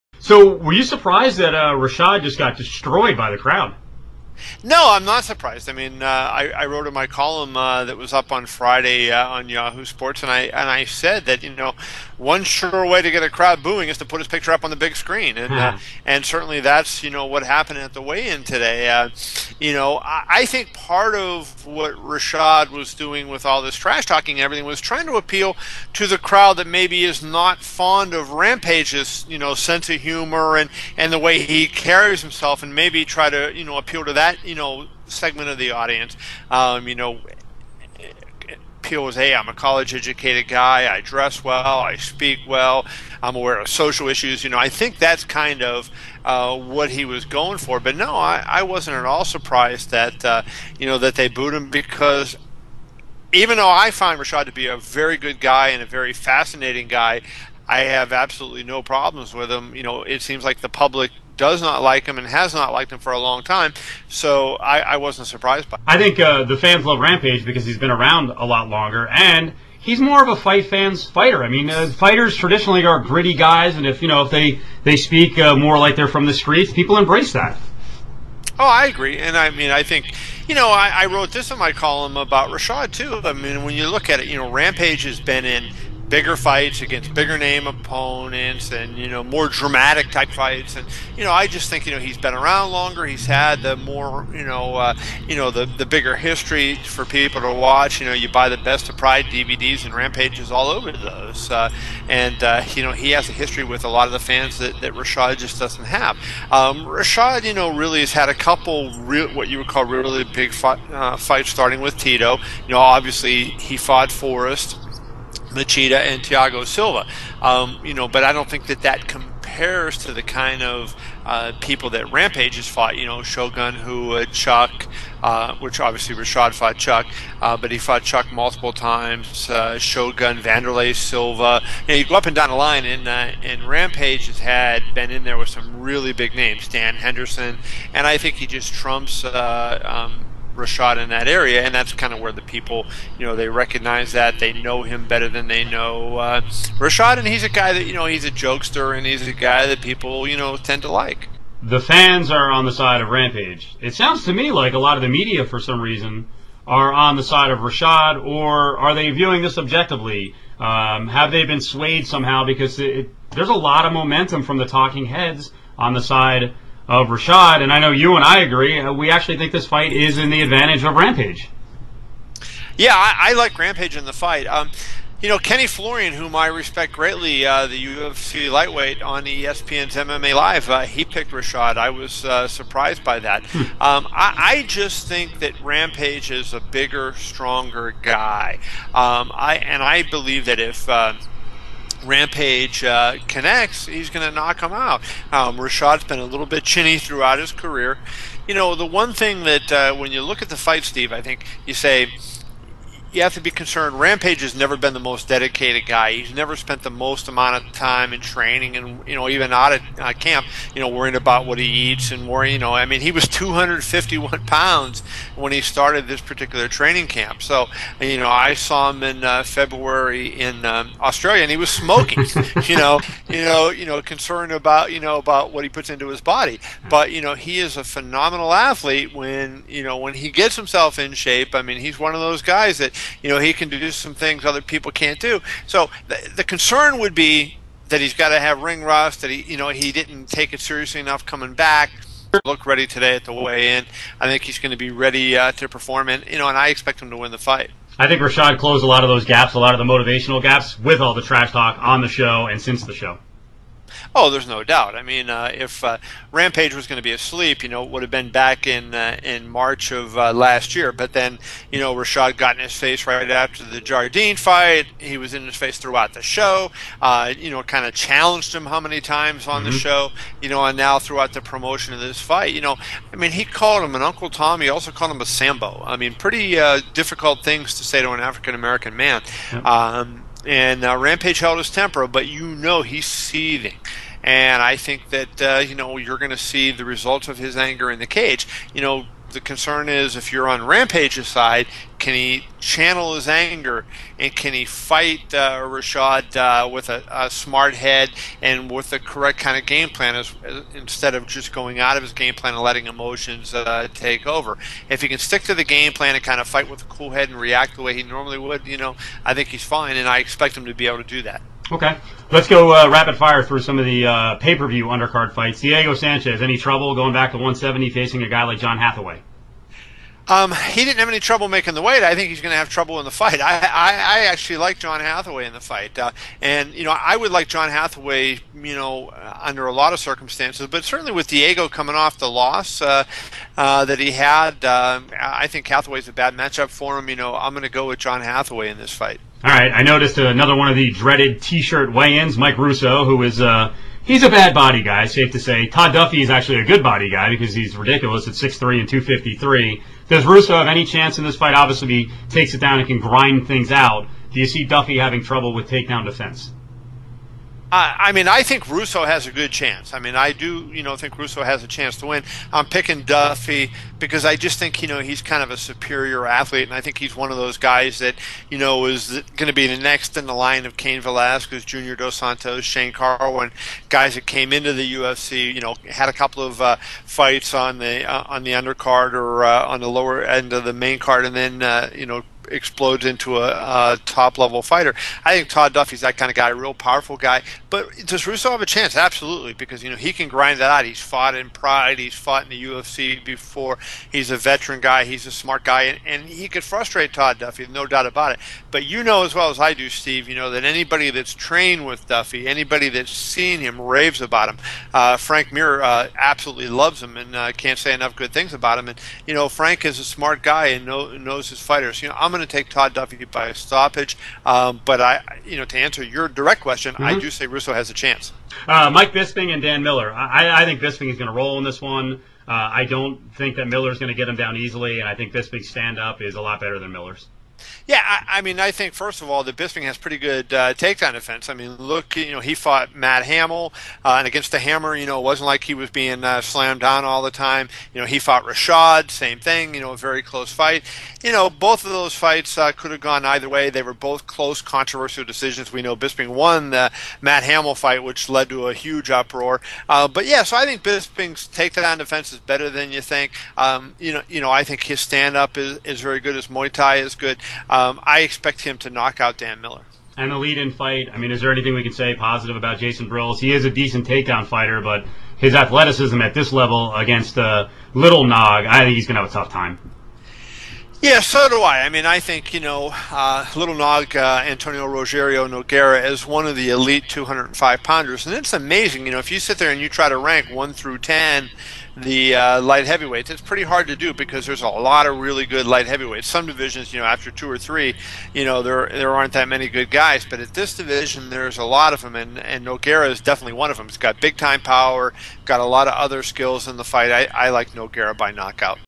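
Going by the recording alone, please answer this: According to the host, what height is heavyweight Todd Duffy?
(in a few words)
6'3.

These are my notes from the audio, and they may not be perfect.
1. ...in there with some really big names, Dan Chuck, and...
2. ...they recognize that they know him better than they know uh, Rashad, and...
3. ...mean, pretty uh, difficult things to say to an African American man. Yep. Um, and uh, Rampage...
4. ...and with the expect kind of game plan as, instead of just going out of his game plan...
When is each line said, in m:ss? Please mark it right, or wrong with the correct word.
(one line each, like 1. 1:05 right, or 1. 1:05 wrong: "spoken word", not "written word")
1. 2:15 wrong: "Henderson", not "Chuck"
2. 2:23 right
3. 4:35 right
4. 4:58 wrong: "correct", not "expect".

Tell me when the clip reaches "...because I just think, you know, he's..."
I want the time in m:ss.
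6:03.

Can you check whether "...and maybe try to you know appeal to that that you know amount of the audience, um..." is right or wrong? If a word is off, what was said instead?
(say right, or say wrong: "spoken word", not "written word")
wrong: "segment", not "amount".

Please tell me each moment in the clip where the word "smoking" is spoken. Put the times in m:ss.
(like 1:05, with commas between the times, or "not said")
3:41.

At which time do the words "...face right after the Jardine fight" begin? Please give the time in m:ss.
4:22.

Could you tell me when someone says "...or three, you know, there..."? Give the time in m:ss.
8:07.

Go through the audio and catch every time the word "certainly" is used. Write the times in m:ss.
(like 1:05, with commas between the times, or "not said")
0:16, 5:30.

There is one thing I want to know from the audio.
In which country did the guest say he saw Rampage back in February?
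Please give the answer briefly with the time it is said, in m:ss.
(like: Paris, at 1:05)
Australia, at 3:41.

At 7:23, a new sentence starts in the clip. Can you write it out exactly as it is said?
They were both close, controversial decisions.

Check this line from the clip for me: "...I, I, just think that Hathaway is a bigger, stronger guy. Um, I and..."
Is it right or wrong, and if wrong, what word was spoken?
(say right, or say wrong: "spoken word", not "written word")
wrong: "Rampage", not "Hathaway".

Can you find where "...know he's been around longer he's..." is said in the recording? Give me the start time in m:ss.
1:31.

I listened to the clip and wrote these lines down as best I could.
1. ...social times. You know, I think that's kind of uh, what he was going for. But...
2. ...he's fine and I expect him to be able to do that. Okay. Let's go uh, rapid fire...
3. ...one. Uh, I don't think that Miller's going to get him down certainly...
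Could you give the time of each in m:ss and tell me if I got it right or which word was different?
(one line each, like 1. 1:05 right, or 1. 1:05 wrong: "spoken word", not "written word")
1. 0:43 wrong: "issues", not "times"
2. 5:09 right
3. 7:01 wrong: "easily", not "certainly".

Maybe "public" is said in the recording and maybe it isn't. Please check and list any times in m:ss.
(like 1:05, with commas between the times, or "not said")
1:00.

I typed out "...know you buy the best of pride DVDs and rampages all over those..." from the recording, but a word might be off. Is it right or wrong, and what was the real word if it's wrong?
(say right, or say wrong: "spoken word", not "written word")
right.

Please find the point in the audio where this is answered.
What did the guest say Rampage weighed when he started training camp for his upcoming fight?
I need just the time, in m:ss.
3:33.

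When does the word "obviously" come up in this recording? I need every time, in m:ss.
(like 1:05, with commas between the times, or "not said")
1:52, 2:05, 5:51.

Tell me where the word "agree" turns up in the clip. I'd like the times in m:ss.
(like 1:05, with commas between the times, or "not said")
1:18, 2:48.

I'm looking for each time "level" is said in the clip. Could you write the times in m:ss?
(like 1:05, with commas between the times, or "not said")
6:24, 7:46.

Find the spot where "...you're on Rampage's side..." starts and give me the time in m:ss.
4:50.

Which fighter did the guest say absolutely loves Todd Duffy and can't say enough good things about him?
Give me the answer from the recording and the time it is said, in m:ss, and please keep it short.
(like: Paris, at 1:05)
Frank Mir, at 6:45.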